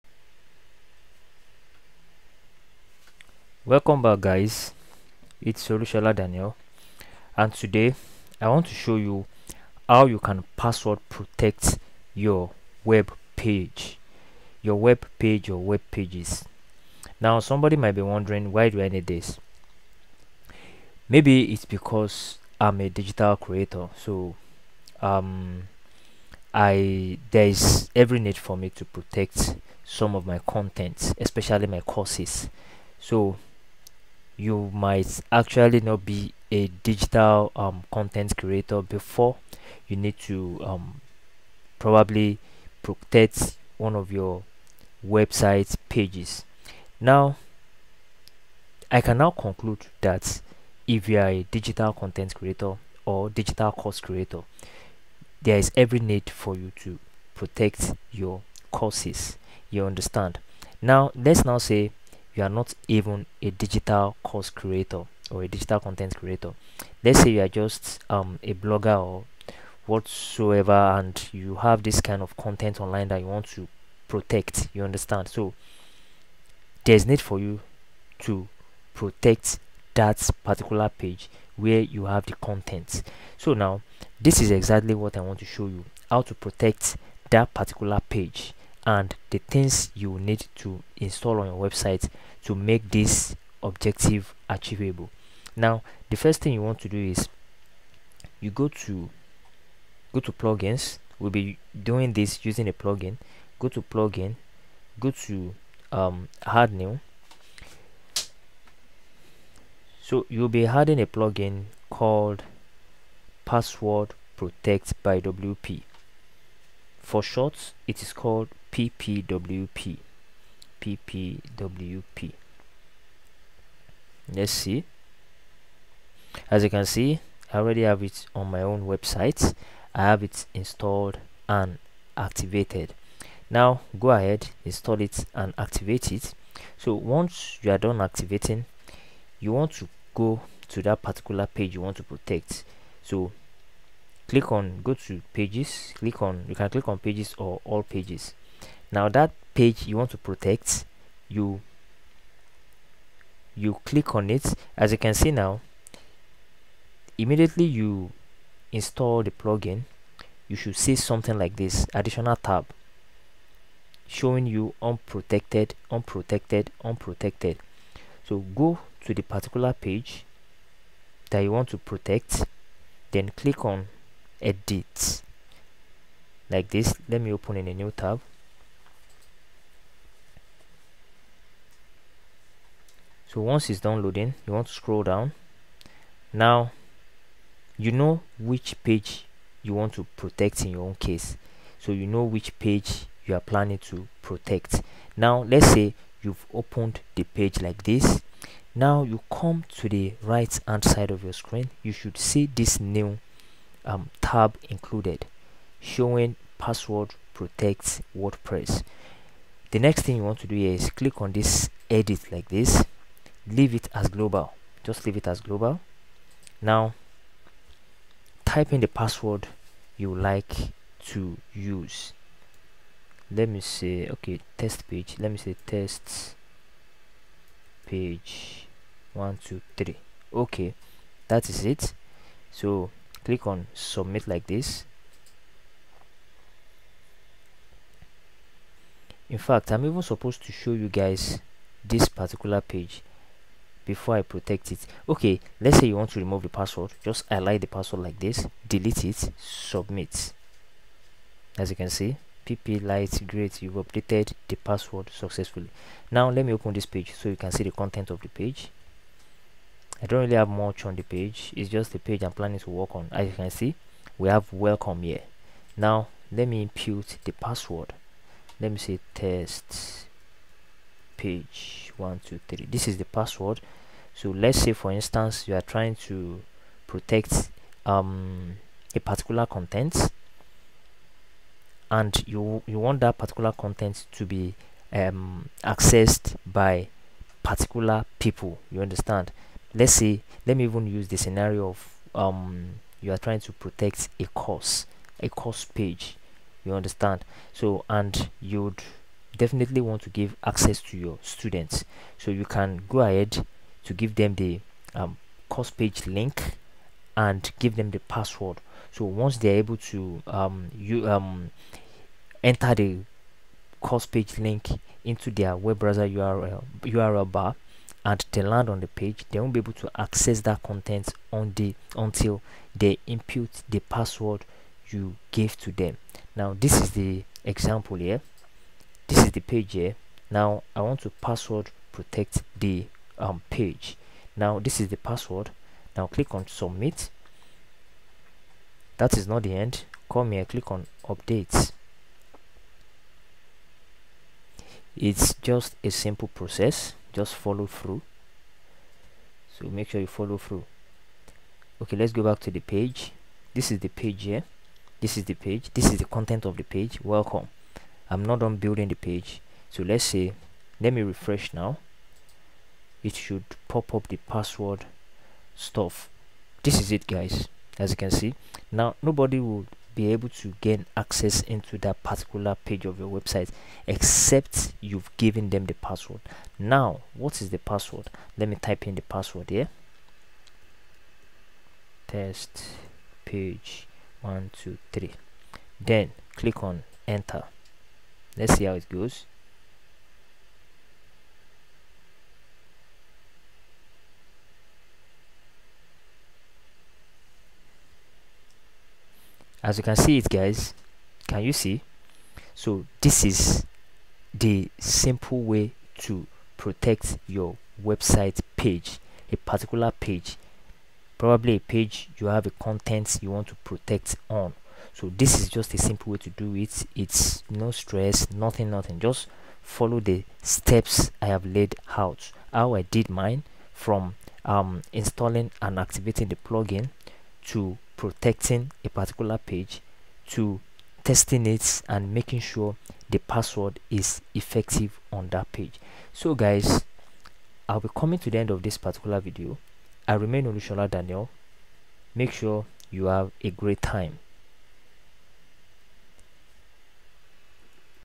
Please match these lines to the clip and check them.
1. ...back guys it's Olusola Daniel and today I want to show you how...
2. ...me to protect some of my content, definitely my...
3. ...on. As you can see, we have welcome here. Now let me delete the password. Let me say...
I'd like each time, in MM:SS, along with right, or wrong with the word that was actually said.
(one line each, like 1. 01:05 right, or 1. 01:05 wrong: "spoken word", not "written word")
1. 00:04 right
2. 00:28 wrong: "especially", not "definitely"
3. 04:22 wrong: "impute", not "delete".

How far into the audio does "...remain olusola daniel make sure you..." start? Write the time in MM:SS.
07:20.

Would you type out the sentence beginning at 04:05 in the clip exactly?
Okay, let's say you want to remove the password.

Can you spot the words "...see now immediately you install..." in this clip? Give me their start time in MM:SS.
02:35.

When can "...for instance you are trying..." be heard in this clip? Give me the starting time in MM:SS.
04:34.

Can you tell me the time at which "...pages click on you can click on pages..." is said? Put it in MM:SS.
02:25.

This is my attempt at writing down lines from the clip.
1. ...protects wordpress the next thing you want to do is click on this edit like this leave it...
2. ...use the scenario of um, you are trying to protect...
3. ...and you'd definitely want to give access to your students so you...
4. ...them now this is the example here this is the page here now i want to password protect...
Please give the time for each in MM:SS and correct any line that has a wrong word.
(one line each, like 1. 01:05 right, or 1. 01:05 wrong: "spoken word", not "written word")
1. 03:27 right
2. 04:50 right
3. 04:57 right
4. 05:25 right.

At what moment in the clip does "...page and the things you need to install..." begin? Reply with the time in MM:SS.
01:28.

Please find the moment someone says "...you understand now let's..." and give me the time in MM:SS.
00:59.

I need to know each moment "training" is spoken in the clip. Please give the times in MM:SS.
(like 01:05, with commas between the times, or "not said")
not said.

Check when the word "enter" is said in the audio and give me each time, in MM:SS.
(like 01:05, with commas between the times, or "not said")
05:12, 06:27.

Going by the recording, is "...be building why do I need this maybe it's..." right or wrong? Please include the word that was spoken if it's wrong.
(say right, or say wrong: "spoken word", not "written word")
wrong: "wondering", not "building".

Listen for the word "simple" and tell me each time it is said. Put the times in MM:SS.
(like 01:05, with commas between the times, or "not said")
05:45, 06:44, 06:55.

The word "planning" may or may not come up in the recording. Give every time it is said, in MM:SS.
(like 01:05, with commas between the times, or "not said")
03:13, 04:22.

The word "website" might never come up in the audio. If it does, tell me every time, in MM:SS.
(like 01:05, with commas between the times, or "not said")
00:45, 01:31, 02:08, 06:13, 06:47.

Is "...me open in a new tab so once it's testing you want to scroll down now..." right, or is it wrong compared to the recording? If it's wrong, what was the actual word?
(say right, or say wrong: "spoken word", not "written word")
wrong: "downloading", not "testing".